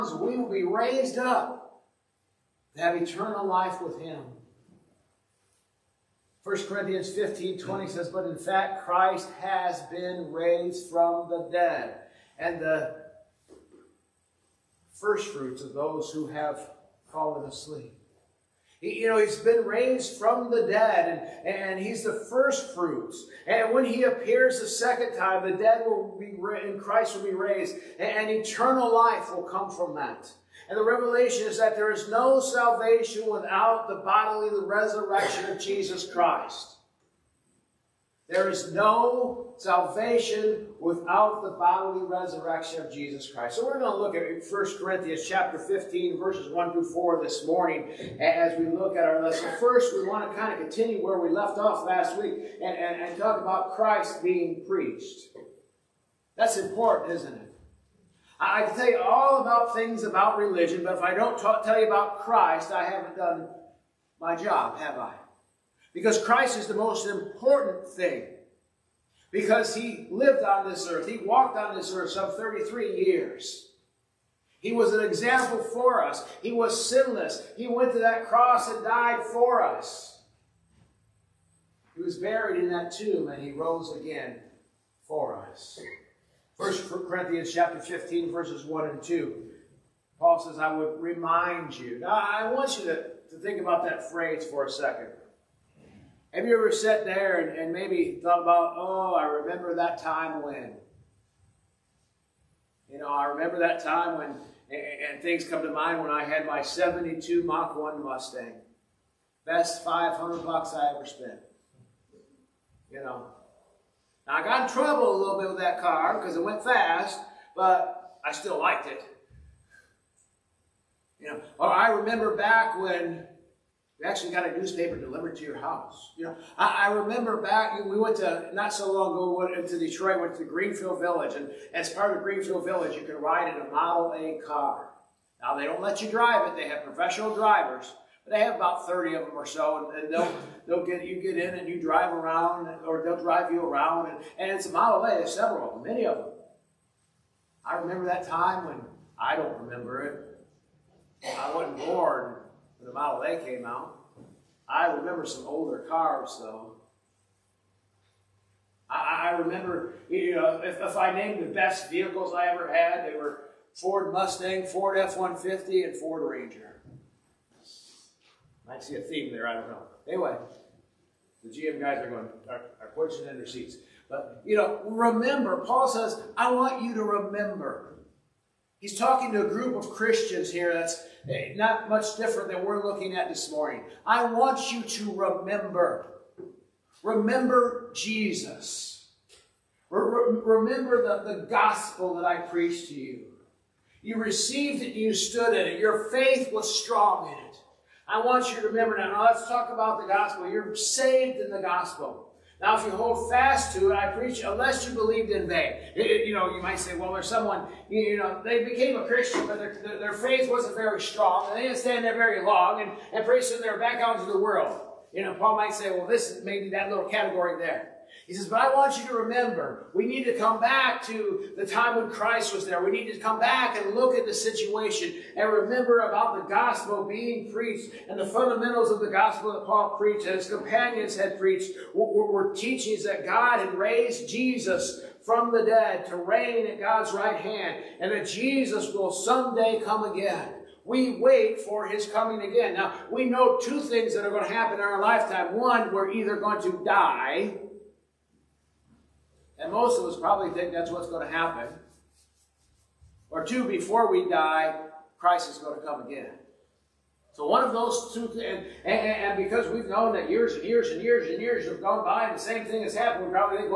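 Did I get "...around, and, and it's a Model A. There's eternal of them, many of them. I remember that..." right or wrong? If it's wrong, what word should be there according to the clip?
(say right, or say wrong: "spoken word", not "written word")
wrong: "several", not "eternal".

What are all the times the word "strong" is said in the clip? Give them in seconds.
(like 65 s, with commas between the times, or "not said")
196 s, 210 s.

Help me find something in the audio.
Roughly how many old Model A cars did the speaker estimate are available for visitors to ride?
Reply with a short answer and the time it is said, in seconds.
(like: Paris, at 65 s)
30, at 138 s.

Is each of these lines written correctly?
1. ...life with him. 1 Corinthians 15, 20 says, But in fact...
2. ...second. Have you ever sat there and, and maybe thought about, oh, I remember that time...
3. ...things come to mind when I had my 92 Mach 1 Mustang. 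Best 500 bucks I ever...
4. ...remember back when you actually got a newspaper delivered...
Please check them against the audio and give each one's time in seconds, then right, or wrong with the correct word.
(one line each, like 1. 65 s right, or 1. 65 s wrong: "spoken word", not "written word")
1. 3 s right
2. 94 s right
3. 105 s wrong: "72", not "92"
4. 121 s right.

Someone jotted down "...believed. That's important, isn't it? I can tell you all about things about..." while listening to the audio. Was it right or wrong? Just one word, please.
wrong.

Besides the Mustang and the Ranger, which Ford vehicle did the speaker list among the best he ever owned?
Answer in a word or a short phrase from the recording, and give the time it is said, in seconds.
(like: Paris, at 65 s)
Ford F-150, at 164 s.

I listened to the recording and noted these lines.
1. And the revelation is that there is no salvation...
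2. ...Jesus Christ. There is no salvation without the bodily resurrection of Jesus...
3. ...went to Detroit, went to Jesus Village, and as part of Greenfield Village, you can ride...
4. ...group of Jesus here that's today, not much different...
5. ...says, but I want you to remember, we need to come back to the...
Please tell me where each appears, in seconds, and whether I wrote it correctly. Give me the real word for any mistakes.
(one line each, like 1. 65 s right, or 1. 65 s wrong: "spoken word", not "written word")
1. 30 s right
2. 35 s right
3. 129 s wrong: "Greenfield", not "Jesus"
4. 179 s wrong: "Christians", not "Jesus"
5. 218 s right.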